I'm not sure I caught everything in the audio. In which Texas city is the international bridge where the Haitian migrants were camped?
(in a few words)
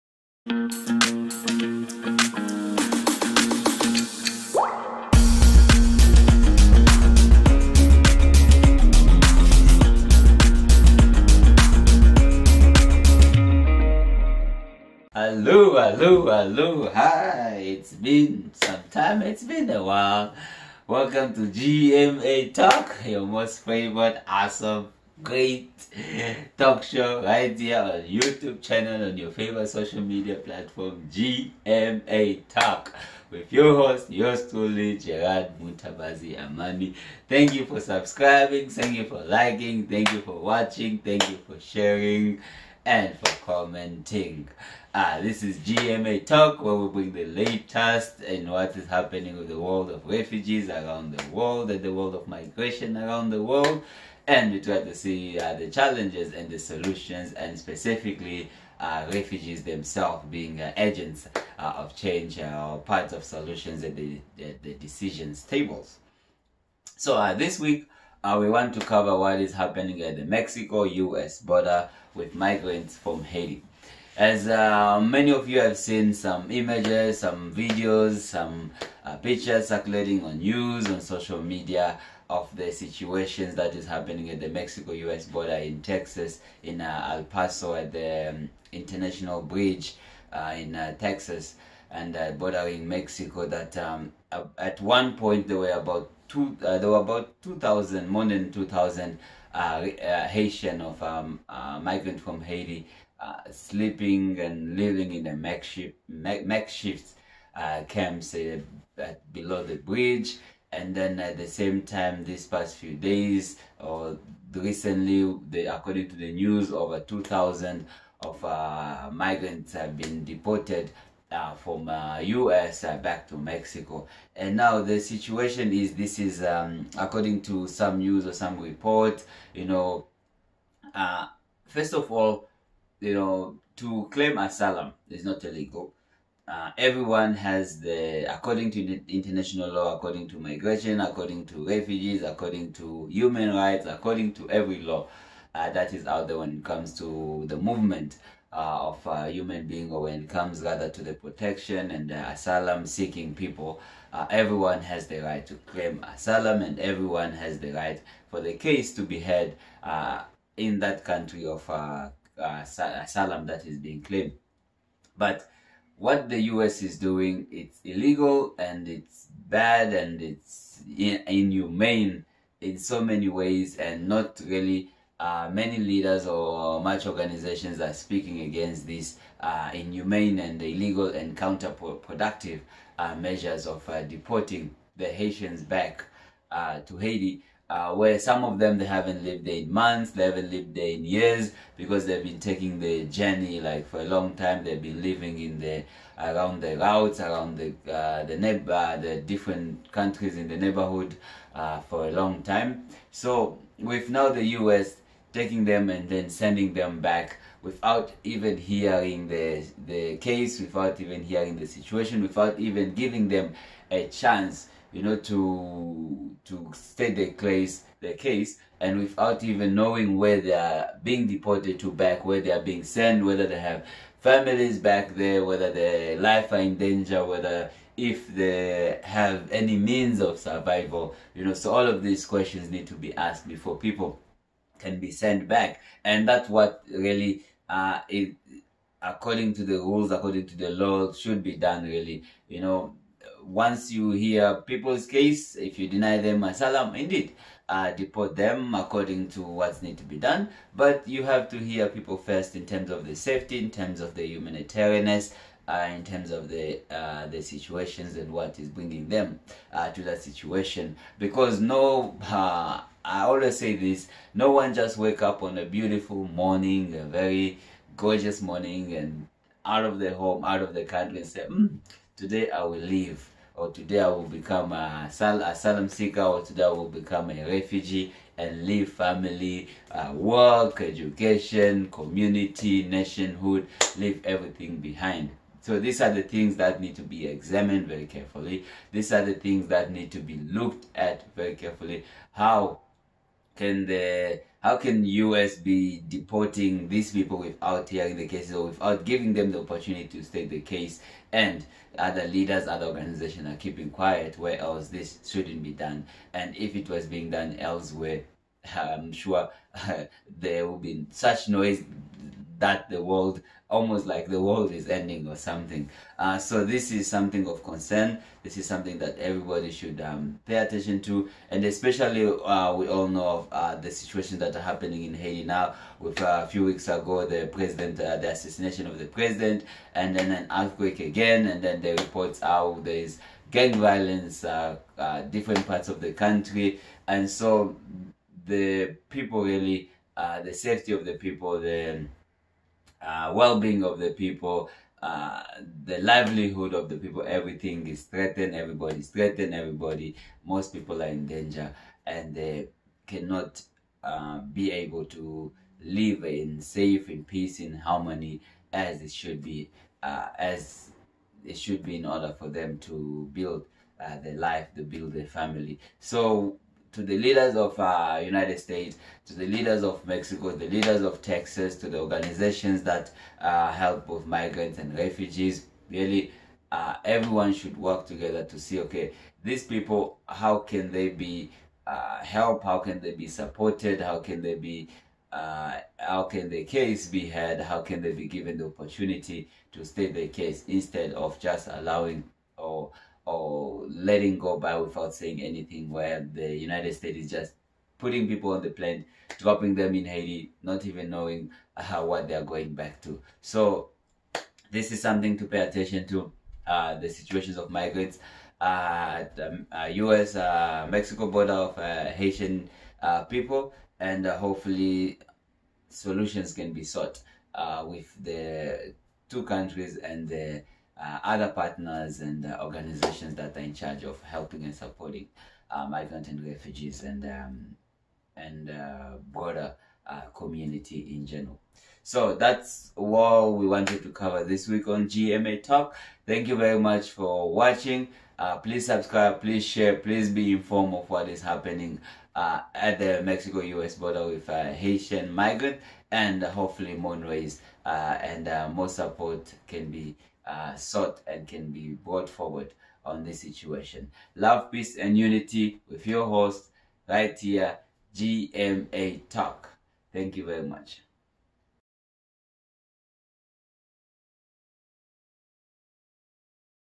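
El Paso.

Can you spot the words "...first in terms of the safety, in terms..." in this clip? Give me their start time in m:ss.
4:12.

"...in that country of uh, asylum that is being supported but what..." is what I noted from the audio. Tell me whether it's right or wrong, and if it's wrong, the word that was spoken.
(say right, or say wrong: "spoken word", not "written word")
wrong: "claimed", not "supported".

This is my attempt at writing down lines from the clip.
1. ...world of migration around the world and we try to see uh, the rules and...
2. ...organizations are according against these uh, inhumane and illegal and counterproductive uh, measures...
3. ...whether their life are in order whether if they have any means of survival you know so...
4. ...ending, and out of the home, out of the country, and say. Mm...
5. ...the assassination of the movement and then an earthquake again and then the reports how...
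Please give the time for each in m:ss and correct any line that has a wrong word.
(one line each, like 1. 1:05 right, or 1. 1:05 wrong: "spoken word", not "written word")
1. 0:51 wrong: "challenges", not "rules"
2. 2:57 wrong: "speaking", not "according"
3. 3:45 wrong: "danger", not "order"
4. 4:28 wrong: "morning", not "ending"
5. 5:28 wrong: "president", not "movement".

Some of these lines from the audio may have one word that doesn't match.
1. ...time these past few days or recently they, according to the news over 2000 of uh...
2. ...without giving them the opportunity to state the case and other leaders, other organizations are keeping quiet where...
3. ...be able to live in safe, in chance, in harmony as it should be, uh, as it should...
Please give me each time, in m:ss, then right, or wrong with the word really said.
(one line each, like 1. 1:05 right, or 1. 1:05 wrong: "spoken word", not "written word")
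1. 1:51 right
2. 4:58 right
3. 5:54 wrong: "peace", not "chance".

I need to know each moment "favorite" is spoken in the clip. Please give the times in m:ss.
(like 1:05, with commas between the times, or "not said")
0:23, 0:29.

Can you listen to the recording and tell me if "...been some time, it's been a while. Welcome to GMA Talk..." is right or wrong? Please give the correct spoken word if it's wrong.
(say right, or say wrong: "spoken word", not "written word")
right.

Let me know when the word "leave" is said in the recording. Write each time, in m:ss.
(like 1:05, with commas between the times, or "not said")
4:32, 4:38, 4:43.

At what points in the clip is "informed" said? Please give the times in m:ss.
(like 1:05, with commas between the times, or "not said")
7:20.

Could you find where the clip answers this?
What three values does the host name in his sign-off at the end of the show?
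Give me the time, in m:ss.
7:34.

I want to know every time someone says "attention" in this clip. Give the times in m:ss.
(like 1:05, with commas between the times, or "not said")
5:20, 6:45.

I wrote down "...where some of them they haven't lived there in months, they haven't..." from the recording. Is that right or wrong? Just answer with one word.
right.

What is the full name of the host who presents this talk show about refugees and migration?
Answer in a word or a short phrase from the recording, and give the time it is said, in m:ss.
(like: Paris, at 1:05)
Gerard Mutabazi Amani, at 0:34.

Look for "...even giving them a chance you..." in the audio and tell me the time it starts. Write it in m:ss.
3:32.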